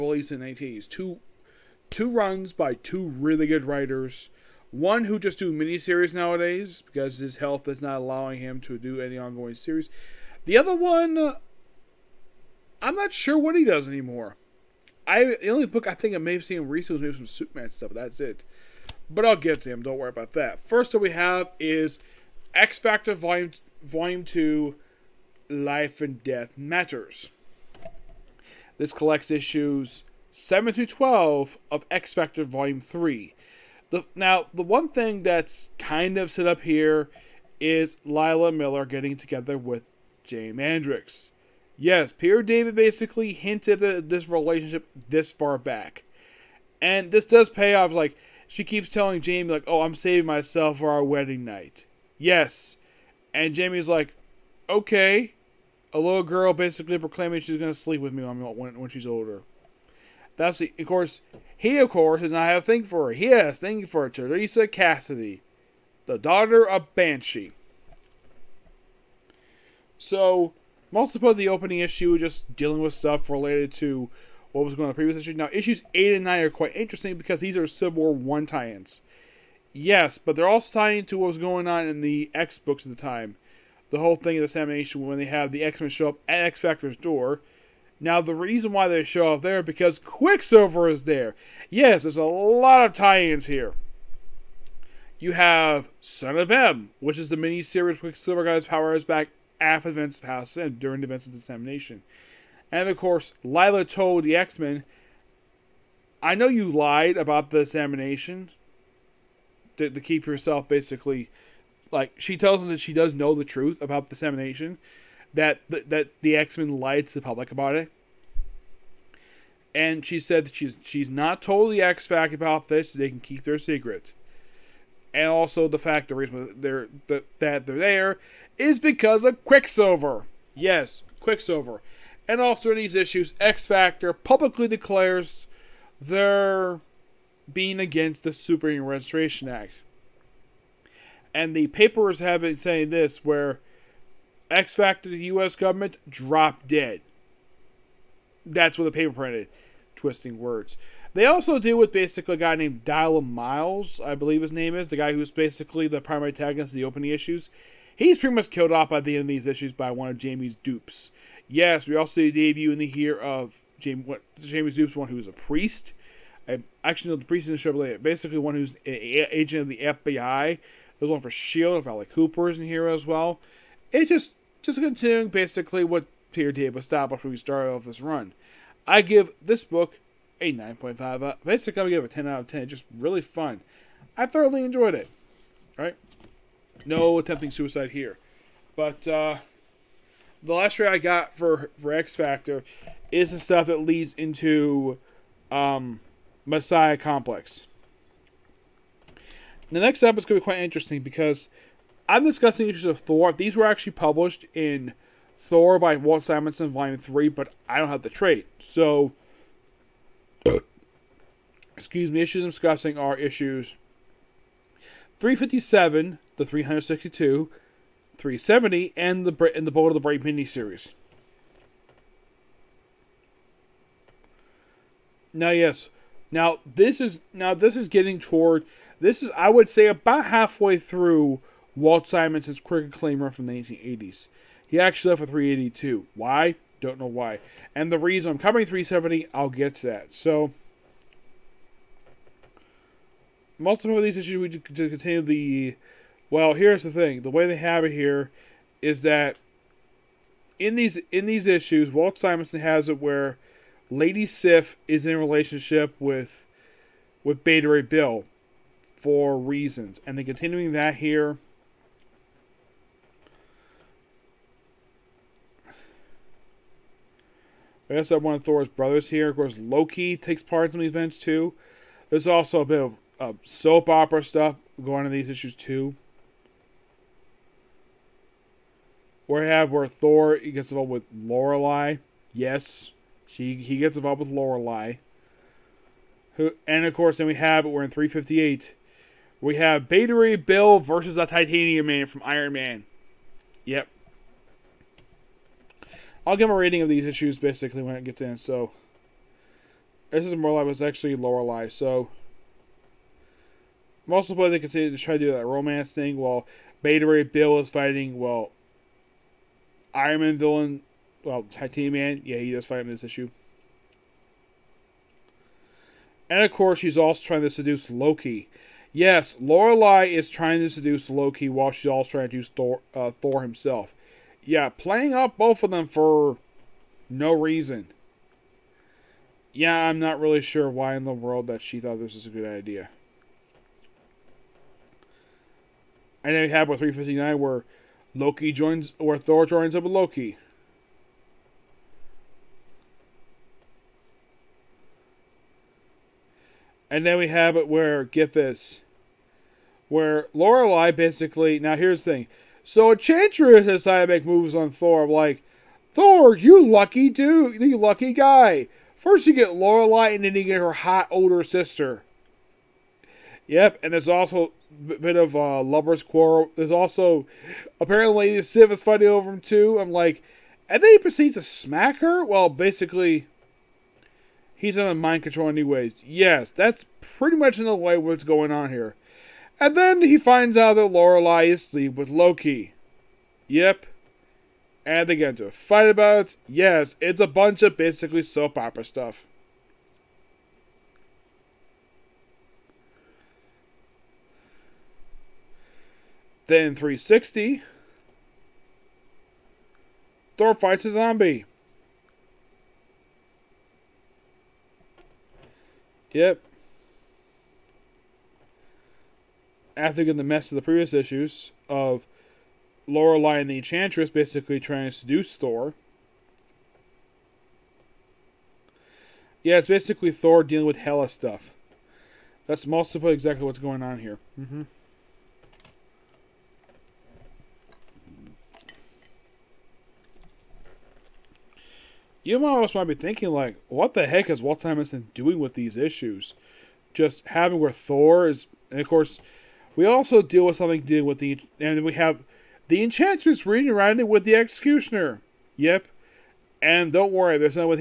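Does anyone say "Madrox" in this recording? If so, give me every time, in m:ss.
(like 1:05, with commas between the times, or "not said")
0:40.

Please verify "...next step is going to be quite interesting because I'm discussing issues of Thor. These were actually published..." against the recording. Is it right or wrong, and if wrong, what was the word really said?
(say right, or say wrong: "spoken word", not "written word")
right.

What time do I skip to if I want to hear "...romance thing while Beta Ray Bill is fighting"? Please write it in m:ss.
5:05.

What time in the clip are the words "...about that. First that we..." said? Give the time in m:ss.
0:20.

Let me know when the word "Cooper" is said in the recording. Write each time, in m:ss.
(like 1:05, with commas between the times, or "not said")
2:52.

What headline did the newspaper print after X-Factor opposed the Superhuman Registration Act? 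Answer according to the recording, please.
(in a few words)
Dropped dead.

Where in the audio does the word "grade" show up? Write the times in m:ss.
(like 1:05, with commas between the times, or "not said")
not said.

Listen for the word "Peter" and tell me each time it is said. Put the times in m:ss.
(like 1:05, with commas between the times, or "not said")
0:42, 2:56.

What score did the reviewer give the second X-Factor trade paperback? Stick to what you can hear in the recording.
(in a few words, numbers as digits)
9.5.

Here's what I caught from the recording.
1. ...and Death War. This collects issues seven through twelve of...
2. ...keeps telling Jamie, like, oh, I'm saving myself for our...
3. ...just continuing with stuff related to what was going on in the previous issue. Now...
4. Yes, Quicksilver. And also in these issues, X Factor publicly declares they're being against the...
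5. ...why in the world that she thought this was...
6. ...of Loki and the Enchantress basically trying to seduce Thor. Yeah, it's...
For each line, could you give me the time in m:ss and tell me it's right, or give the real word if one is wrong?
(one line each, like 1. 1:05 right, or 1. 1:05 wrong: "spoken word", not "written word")
1. 0:25 wrong: "Matters", not "War"
2. 0:48 right
3. 1:12 wrong: "dealing", not "continuing"
4. 2:10 right
5. 5:30 right
6. 6:51 wrong: "Lorelei", not "Loki".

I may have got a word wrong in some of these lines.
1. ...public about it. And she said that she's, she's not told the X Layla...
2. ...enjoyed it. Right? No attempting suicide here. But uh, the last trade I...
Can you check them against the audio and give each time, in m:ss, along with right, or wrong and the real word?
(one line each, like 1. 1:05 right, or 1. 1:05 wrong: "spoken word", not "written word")
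1. 1:57 wrong: "Fact", not "Layla"
2. 3:04 right.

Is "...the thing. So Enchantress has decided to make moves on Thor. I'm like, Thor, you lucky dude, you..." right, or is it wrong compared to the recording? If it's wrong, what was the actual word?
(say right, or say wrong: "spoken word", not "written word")
right.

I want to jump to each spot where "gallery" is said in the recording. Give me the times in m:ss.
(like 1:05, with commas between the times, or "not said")
not said.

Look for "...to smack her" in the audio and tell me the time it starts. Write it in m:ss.
6:11.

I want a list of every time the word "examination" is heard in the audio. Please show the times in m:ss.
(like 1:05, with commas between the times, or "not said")
1:24, 1:47.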